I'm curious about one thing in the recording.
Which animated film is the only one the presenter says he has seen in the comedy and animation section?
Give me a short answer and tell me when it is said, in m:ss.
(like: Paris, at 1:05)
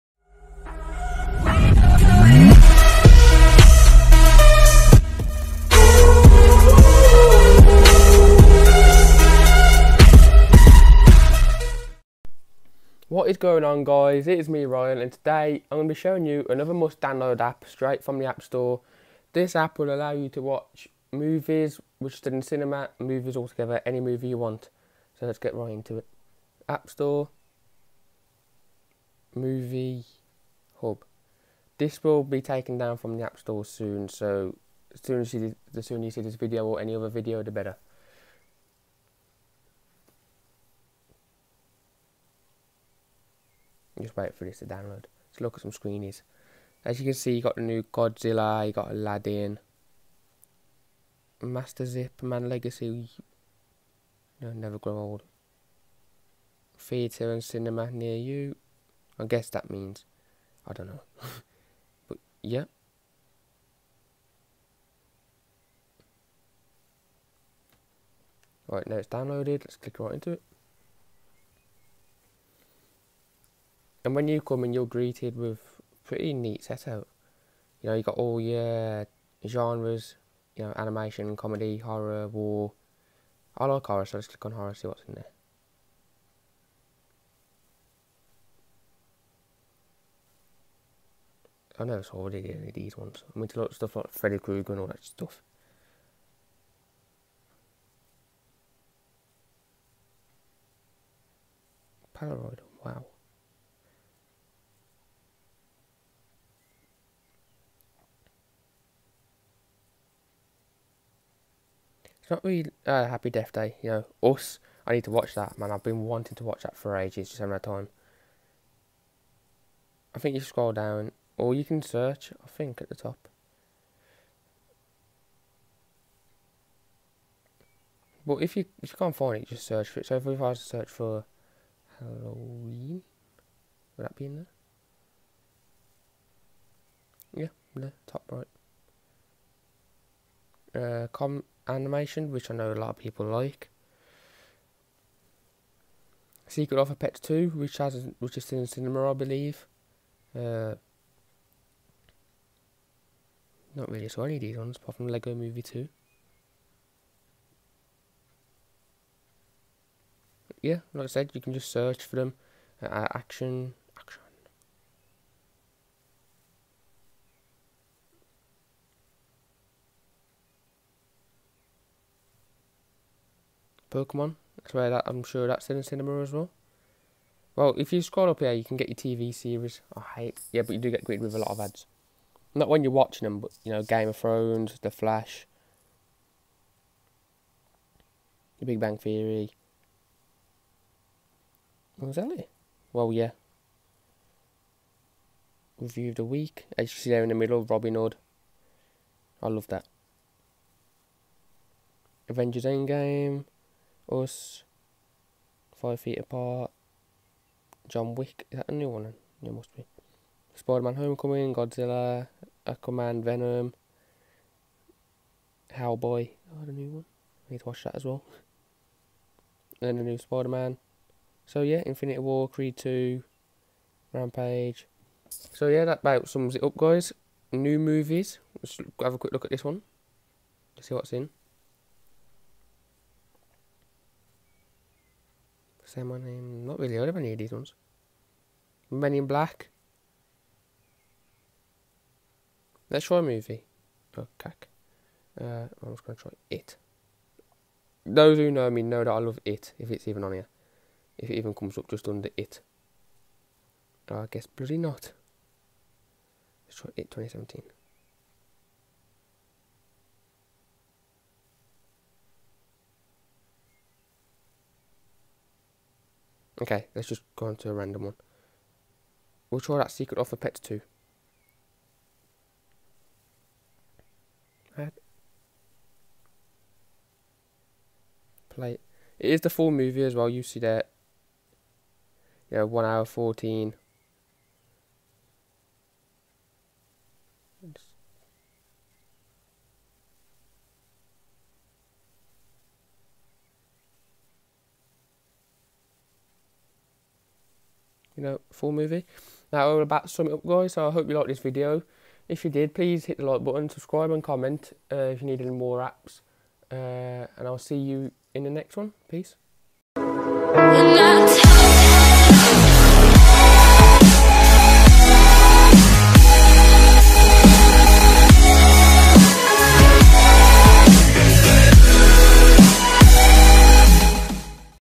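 Lego Movie 2, at 2:35.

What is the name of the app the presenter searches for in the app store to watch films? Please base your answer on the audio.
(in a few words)
Movie Hub.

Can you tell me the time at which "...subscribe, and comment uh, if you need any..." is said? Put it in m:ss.
5:03.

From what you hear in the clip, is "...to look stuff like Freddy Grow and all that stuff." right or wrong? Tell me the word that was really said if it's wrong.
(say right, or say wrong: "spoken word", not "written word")
wrong: "Krueger", not "Grow".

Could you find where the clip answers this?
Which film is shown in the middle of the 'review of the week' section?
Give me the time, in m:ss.
3:17.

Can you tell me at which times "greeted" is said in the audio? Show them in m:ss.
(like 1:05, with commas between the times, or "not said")
1:14, 3:01.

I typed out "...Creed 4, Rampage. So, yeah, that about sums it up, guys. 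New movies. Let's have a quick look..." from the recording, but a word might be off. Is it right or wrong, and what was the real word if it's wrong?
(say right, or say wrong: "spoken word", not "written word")
wrong: "2", not "4".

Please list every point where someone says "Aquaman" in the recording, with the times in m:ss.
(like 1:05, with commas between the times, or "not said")
3:32.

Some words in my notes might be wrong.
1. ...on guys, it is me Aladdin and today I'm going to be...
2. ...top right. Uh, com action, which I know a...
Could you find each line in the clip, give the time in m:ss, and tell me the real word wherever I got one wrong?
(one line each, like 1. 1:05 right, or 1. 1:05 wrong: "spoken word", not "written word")
1. 0:13 wrong: "Ryan", not "Aladdin"
2. 2:18 wrong: "animation", not "action".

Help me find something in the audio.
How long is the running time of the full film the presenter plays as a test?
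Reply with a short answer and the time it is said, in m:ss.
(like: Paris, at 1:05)
1 hour 14, at 4:42.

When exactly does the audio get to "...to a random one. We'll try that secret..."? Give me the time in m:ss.
4:27.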